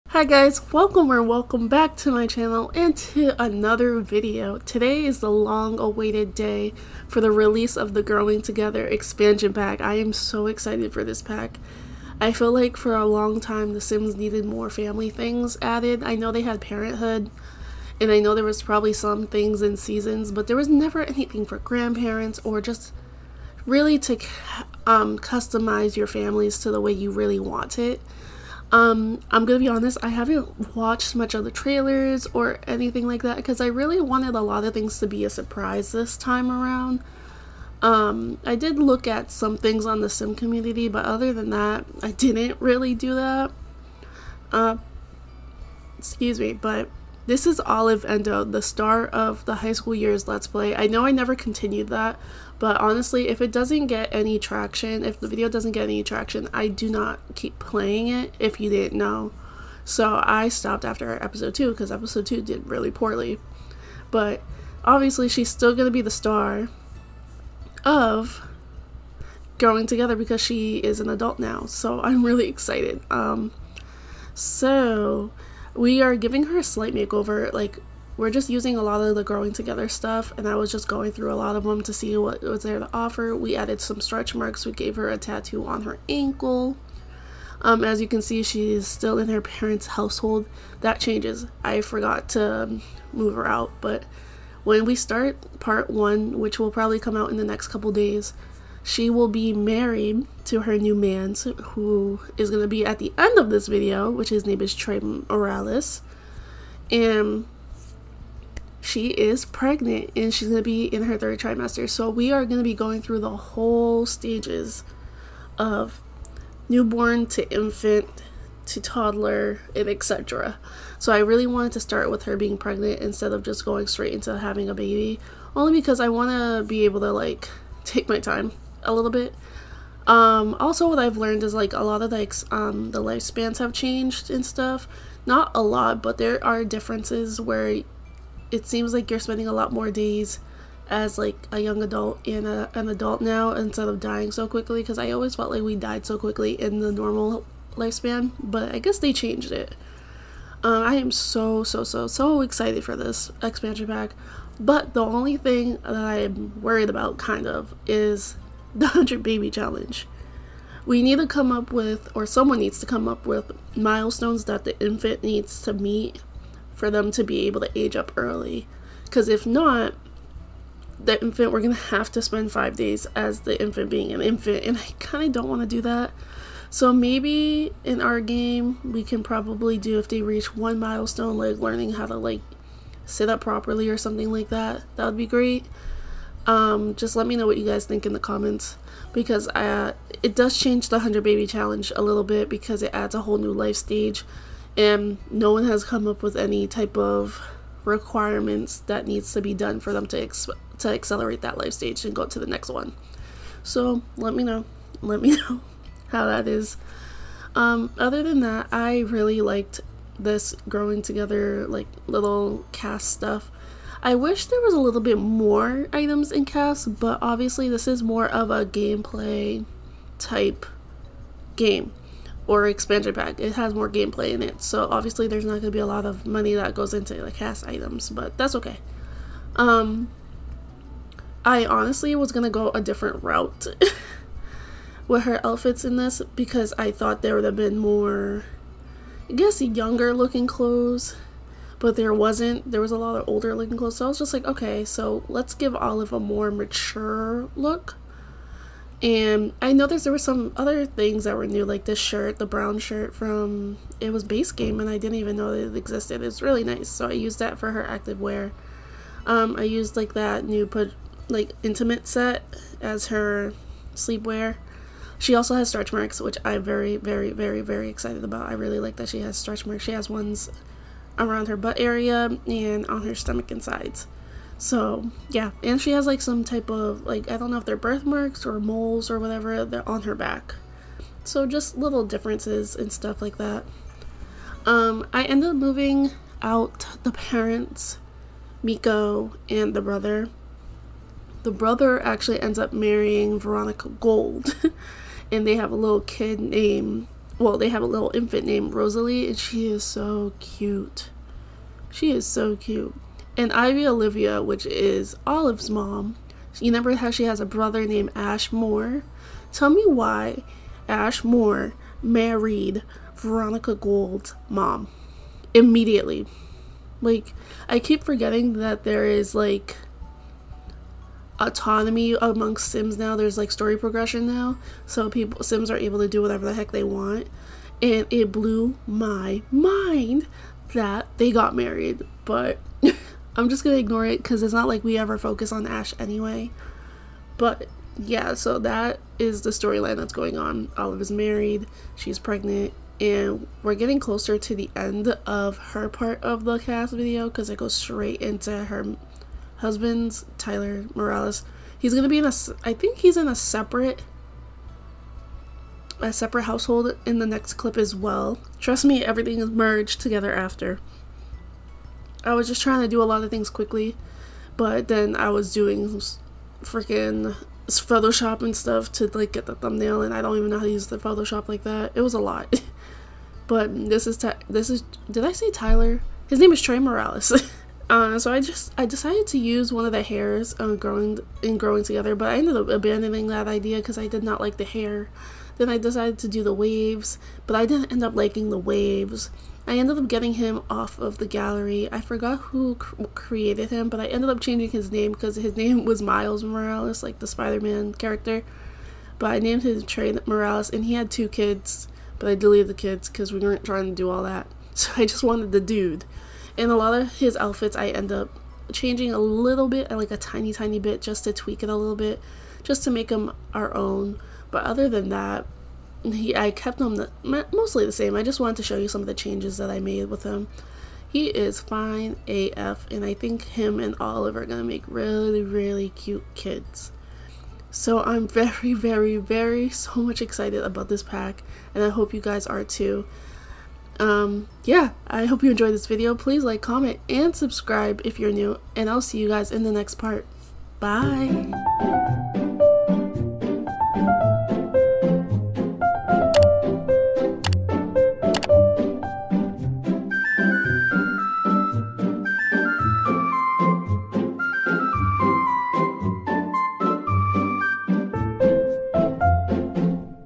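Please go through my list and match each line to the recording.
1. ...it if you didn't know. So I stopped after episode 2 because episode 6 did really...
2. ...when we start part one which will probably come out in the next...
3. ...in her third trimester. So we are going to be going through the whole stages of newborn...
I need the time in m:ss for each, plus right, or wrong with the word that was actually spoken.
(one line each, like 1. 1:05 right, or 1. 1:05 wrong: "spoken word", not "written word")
1. 0:58 wrong: "2", not "6"
2. 1:34 right
3. 1:50 right.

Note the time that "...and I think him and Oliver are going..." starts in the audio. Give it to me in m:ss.
7:02.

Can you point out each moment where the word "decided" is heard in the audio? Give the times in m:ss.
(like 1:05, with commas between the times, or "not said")
6:18, 6:25.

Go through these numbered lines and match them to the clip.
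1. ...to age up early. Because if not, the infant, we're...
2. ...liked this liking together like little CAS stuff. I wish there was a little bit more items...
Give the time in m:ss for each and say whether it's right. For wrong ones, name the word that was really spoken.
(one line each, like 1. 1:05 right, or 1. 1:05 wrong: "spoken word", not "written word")
1. 2:47 right
2. 3:29 wrong: "growing", not "liking".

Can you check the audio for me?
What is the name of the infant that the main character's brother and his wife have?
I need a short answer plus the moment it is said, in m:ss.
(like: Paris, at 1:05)
Rosalie, at 4:58.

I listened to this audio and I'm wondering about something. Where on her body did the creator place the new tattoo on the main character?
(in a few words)
Her ankle.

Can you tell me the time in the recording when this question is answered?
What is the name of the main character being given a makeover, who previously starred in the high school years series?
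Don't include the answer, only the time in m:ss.
0:47.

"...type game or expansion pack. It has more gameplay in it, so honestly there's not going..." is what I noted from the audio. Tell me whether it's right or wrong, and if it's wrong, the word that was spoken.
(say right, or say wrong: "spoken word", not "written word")
wrong: "obviously", not "honestly".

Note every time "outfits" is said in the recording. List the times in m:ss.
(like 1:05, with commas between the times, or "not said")
3:55, 6:47.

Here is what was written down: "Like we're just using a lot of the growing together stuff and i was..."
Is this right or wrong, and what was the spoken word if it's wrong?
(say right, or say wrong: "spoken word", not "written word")
right.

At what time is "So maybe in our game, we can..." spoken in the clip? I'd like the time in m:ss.
2:56.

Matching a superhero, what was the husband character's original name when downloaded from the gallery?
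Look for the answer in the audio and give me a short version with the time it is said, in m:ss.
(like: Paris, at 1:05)
Miles Morales, at 6:36.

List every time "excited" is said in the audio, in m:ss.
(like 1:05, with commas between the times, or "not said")
0:10, 1:12, 2:32, 4:27, 7:10.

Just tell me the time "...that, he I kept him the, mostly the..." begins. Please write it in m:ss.
6:55.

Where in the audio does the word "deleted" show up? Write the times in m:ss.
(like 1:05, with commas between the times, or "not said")
6:42.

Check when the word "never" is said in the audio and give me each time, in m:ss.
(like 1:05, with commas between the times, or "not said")
0:20, 0:51.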